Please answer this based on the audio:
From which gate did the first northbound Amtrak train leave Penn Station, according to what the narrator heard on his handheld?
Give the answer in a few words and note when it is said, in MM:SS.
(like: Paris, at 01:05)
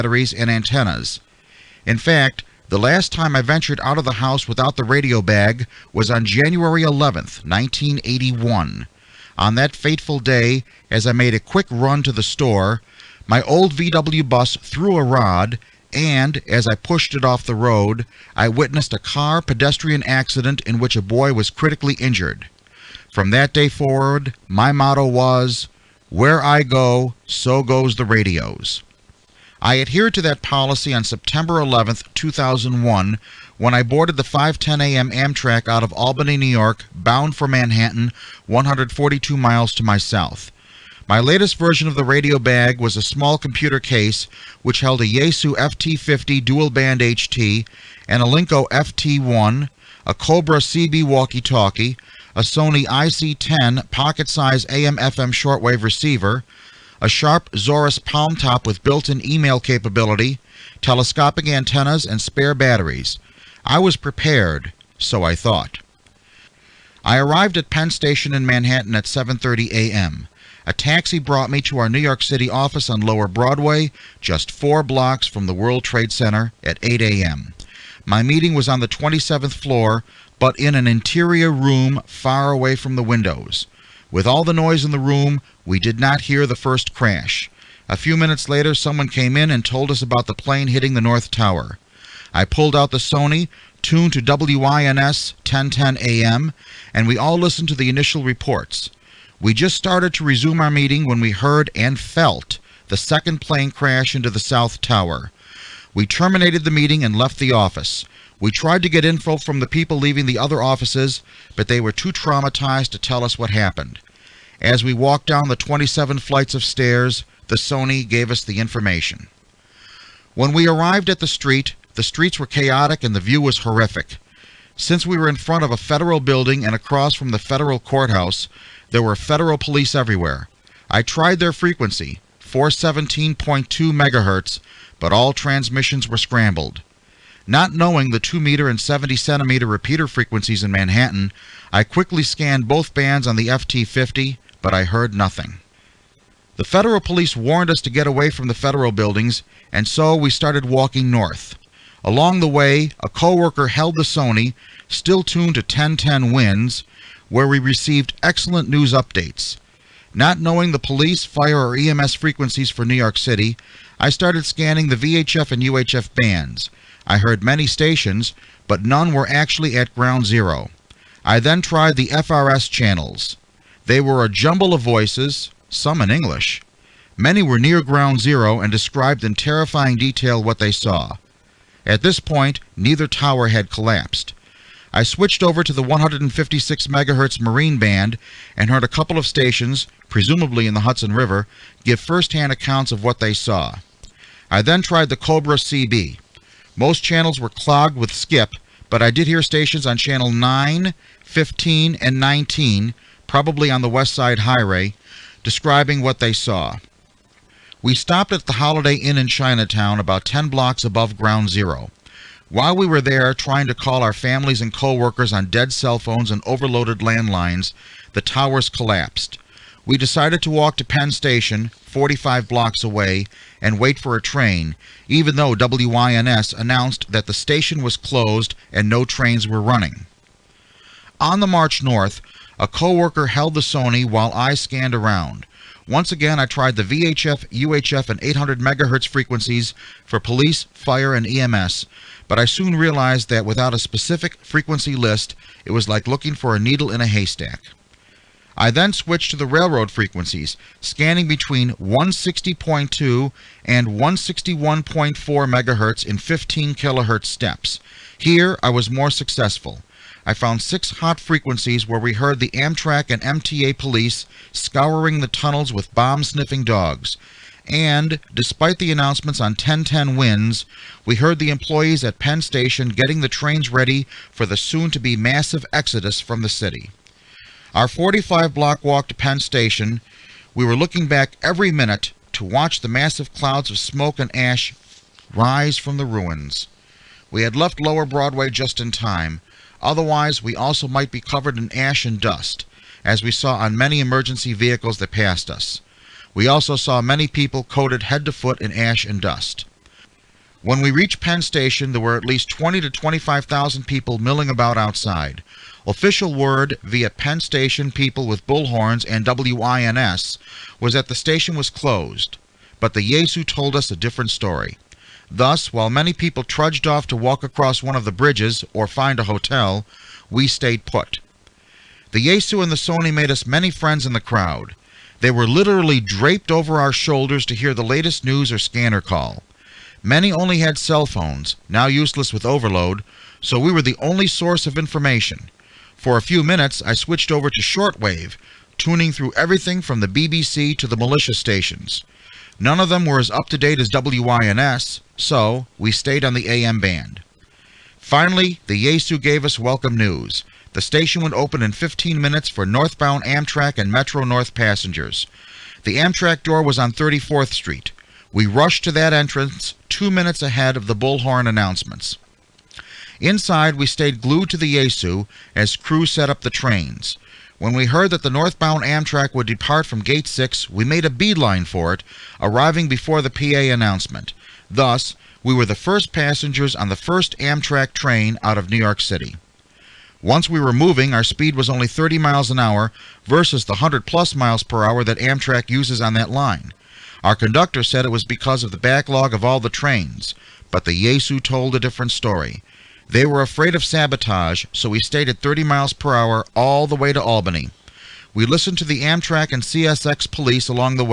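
Gate 6, at 06:10.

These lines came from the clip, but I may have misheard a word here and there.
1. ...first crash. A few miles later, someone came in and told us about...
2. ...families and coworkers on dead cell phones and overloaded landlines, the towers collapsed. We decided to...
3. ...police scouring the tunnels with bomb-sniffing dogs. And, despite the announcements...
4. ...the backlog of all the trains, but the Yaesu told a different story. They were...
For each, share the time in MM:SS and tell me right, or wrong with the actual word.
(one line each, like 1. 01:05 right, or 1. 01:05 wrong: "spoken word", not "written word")
1. 01:26 wrong: "minutes", not "miles"
2. 03:34 right
3. 04:23 right
4. 06:28 right.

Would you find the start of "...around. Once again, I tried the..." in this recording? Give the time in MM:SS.
03:54.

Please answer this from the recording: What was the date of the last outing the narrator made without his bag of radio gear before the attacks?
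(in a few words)
January 11th, 1981.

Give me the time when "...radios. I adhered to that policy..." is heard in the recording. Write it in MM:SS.
00:28.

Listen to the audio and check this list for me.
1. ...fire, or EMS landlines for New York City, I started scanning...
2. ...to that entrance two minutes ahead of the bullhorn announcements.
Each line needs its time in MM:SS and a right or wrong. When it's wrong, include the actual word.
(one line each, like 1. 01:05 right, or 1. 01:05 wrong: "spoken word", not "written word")
1. 02:41 wrong: "frequencies", not "landlines"
2. 05:58 right.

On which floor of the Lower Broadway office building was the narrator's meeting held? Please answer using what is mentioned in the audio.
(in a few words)
27th floor.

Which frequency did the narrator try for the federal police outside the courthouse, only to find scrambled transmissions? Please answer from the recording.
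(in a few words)
417.2 MHz.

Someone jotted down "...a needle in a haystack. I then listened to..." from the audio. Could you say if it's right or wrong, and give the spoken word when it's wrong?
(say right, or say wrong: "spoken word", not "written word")
wrong: "switched", not "listened".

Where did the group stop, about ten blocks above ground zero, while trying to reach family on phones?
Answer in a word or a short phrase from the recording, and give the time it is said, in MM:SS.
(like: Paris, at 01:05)
Holiday Inn in Chinatown, at 03:28.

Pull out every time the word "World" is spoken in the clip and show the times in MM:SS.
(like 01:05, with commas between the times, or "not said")
01:15.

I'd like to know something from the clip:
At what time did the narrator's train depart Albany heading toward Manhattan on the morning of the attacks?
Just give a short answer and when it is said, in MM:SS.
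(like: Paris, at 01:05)
5:10 a.m., at 00:34.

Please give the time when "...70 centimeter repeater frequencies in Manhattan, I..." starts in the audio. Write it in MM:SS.
02:18.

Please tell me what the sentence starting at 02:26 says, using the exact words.
The federal police warned us to get away from the federal buildings, and so we started walking north.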